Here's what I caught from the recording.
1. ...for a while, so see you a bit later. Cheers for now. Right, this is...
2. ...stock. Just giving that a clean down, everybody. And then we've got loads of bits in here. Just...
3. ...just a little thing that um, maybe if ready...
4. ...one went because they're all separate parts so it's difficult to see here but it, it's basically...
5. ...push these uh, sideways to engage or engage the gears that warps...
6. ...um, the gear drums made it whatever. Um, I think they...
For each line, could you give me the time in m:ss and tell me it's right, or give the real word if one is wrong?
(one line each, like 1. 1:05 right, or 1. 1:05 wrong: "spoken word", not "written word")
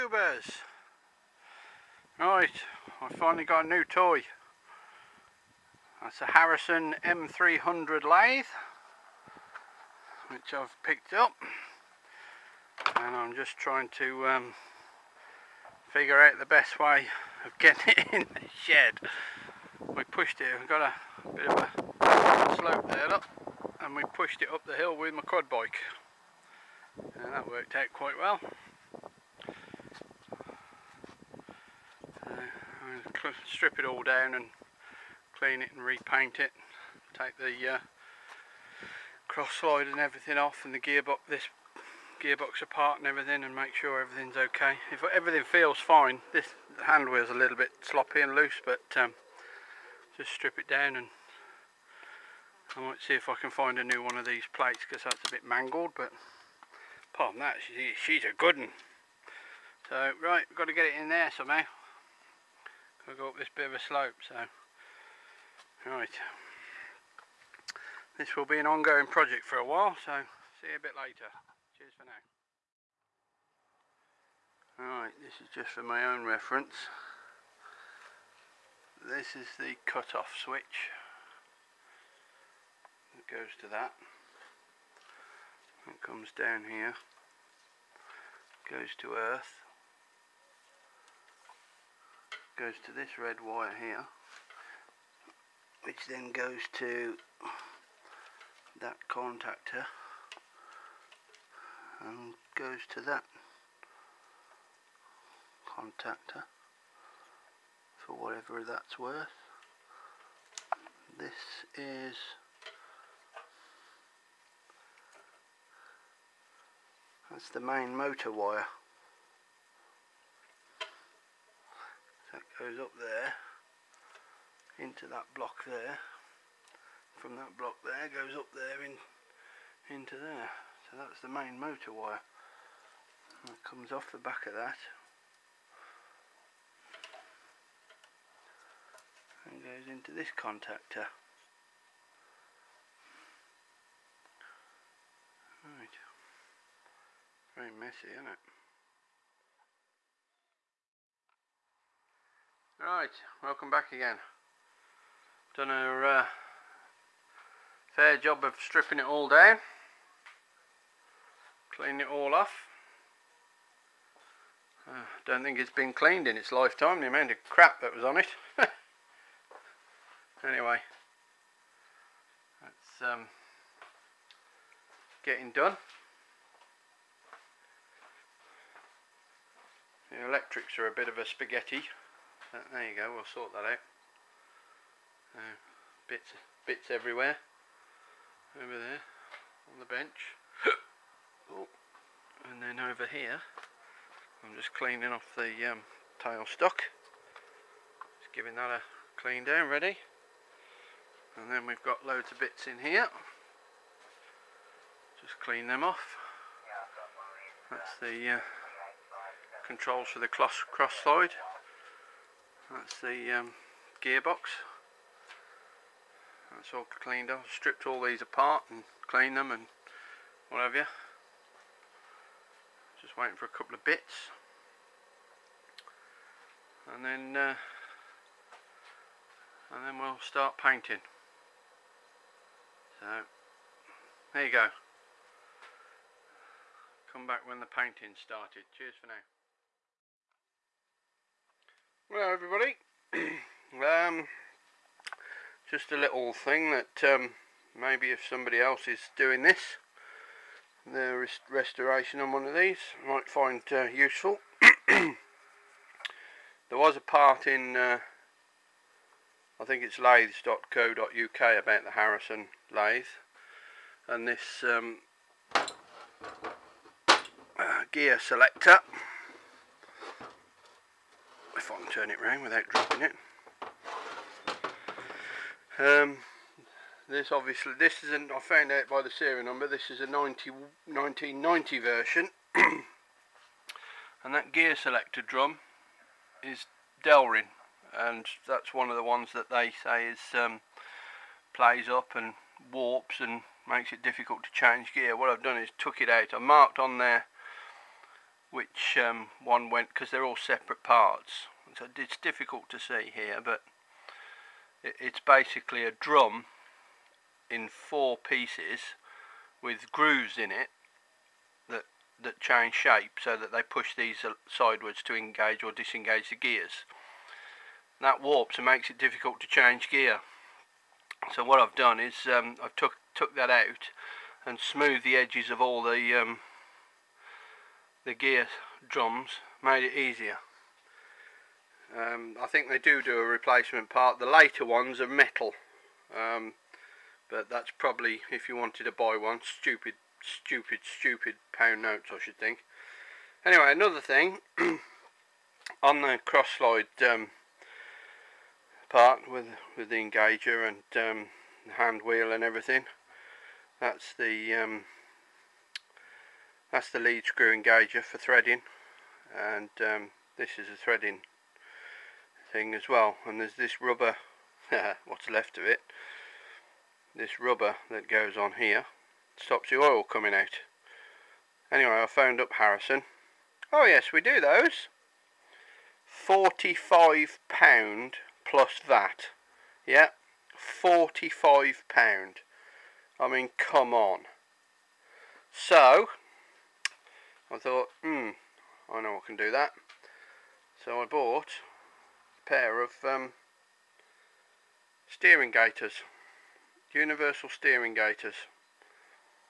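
1. 1:09 right
2. 3:16 wrong: "ready", not "everybody"
3. 4:05 wrong: "somebody", not "ready"
4. 4:59 right
5. 5:13 wrong: "disengage", not "engage"
6. 5:26 wrong: "easier", not "whatever".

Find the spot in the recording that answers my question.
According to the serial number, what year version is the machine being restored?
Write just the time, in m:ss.
4:40.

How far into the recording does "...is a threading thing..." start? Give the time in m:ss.
6:00.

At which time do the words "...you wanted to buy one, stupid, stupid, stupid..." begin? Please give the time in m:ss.
5:38.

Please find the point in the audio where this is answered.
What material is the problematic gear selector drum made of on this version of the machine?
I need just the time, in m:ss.
4:47.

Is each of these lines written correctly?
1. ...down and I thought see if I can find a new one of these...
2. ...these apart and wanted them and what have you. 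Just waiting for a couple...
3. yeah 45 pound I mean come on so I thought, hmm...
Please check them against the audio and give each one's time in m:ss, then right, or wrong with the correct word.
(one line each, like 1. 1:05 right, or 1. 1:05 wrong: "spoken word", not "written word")
1. 0:50 wrong: "might", not "thought"
2. 3:38 wrong: "cleaned", not "wanted"
3. 6:19 right.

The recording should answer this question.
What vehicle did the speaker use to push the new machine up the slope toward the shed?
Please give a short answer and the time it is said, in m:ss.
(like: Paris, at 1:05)
quad bike, at 0:25.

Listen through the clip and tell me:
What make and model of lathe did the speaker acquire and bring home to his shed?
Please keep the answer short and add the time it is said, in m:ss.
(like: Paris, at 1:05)
Harrison M300, at 0:06.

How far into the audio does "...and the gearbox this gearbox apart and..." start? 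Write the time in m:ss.
0:40.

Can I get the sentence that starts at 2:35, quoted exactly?
Done a uh, fair job of stripping it all down.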